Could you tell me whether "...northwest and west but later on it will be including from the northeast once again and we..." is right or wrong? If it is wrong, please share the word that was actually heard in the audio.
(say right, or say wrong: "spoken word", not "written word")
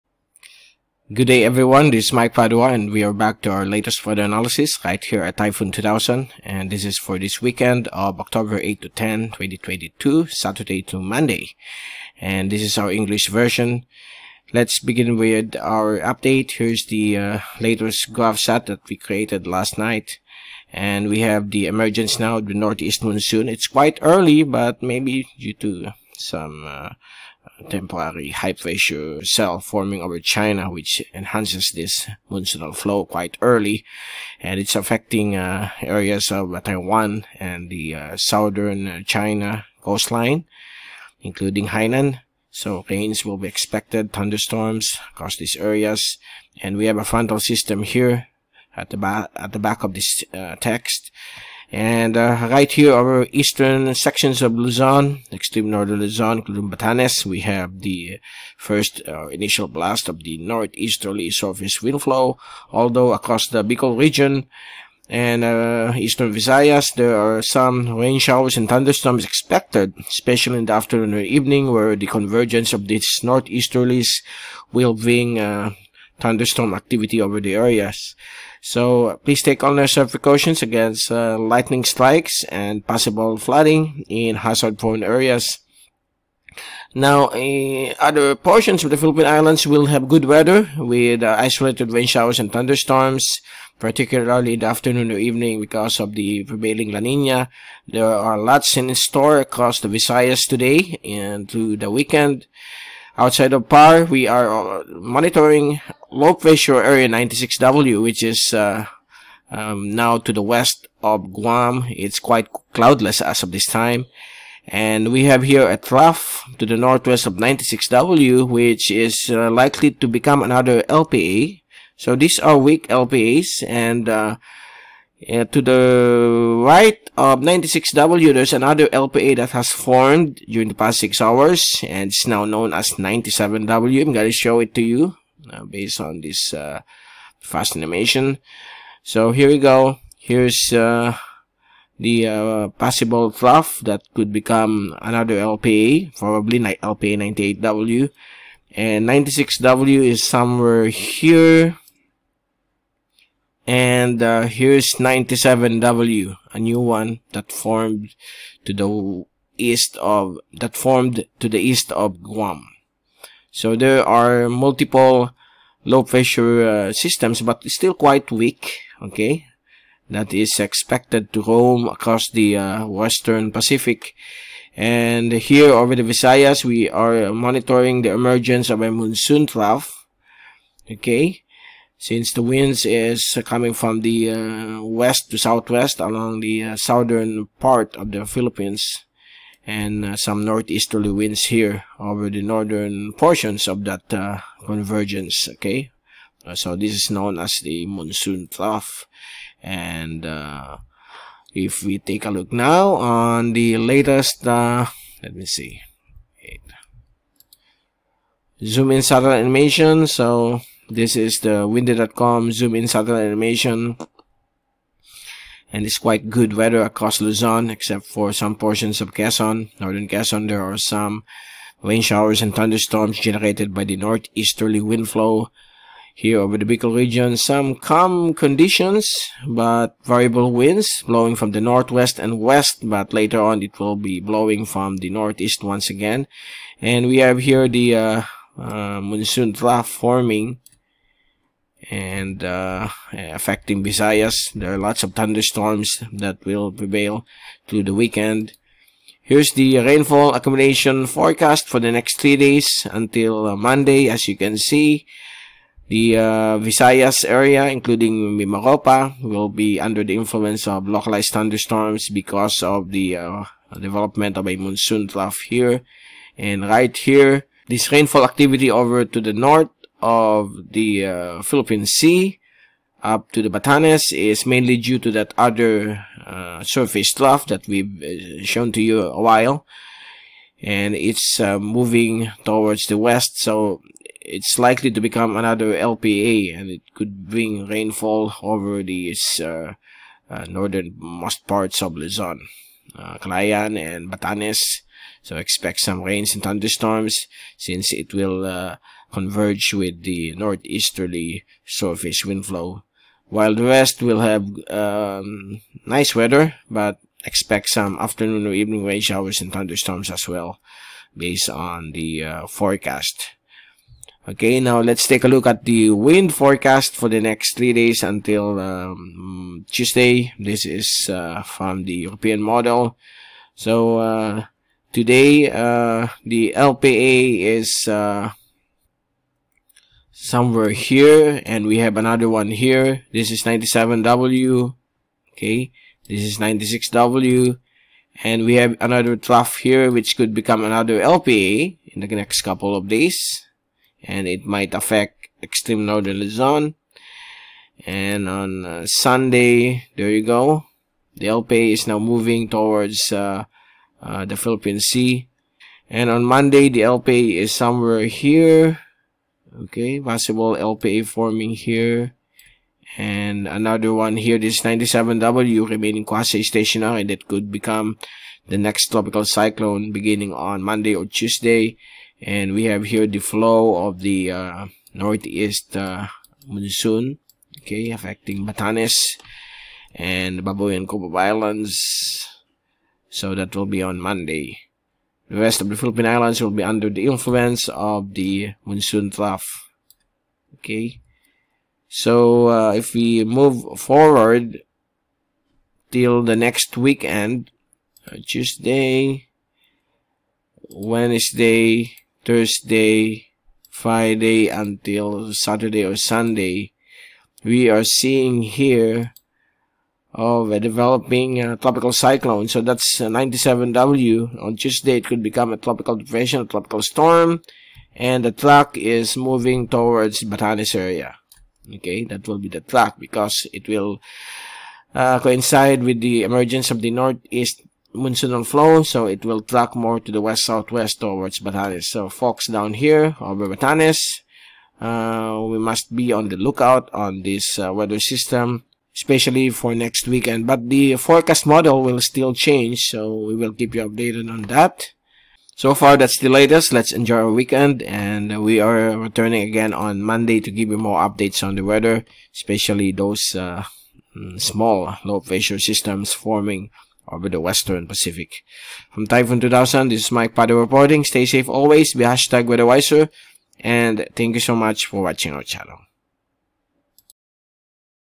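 wrong: "blowing", not "including".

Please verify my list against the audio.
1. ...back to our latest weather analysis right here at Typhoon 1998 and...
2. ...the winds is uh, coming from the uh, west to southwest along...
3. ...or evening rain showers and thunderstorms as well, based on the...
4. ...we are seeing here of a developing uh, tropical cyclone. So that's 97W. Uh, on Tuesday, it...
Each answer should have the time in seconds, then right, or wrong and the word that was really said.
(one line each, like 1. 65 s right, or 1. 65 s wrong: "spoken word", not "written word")
1. 3 s wrong: "2000", not "1998"
2. 182 s right
3. 308 s right
4. 407 s right.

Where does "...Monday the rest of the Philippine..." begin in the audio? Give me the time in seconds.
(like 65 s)
383 s.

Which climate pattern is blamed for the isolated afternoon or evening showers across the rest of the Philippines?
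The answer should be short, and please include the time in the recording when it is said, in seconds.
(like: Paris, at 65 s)
La Nina, at 96 s.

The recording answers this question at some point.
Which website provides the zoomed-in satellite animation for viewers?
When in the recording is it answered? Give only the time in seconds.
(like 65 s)
211 s.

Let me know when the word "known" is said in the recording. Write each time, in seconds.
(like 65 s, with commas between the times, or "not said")
132 s, 197 s.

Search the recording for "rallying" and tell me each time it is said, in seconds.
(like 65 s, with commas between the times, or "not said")
not said.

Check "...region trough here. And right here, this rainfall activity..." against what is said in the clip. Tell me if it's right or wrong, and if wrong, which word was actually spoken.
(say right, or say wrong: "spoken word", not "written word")
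wrong: "monsoon", not "region".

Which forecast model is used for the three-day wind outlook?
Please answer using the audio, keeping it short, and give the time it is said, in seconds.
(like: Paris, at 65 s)
European model, at 322 s.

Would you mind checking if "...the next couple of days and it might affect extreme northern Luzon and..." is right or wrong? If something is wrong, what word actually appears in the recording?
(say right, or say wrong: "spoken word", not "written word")
right.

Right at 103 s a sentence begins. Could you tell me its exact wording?
Outside of PAR, we are uh, monitoring low pressure area 96W, which is uh, um, now to the west of Guam.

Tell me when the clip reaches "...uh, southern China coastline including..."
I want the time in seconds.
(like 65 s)
37 s.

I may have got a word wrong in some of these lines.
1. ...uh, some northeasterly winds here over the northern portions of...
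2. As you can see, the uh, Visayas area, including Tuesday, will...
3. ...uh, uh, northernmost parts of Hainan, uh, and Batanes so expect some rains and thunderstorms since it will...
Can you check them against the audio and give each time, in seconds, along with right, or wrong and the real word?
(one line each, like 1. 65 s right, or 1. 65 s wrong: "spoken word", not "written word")
1. 190 s right
2. 254 s wrong: "Mimaropa", not "Tuesday"
3. 289 s wrong: "Luzon", not "Hainan".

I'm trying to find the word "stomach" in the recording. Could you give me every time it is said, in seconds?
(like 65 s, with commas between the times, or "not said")
not said.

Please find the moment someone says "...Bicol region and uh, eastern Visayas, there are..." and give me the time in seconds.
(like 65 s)
63 s.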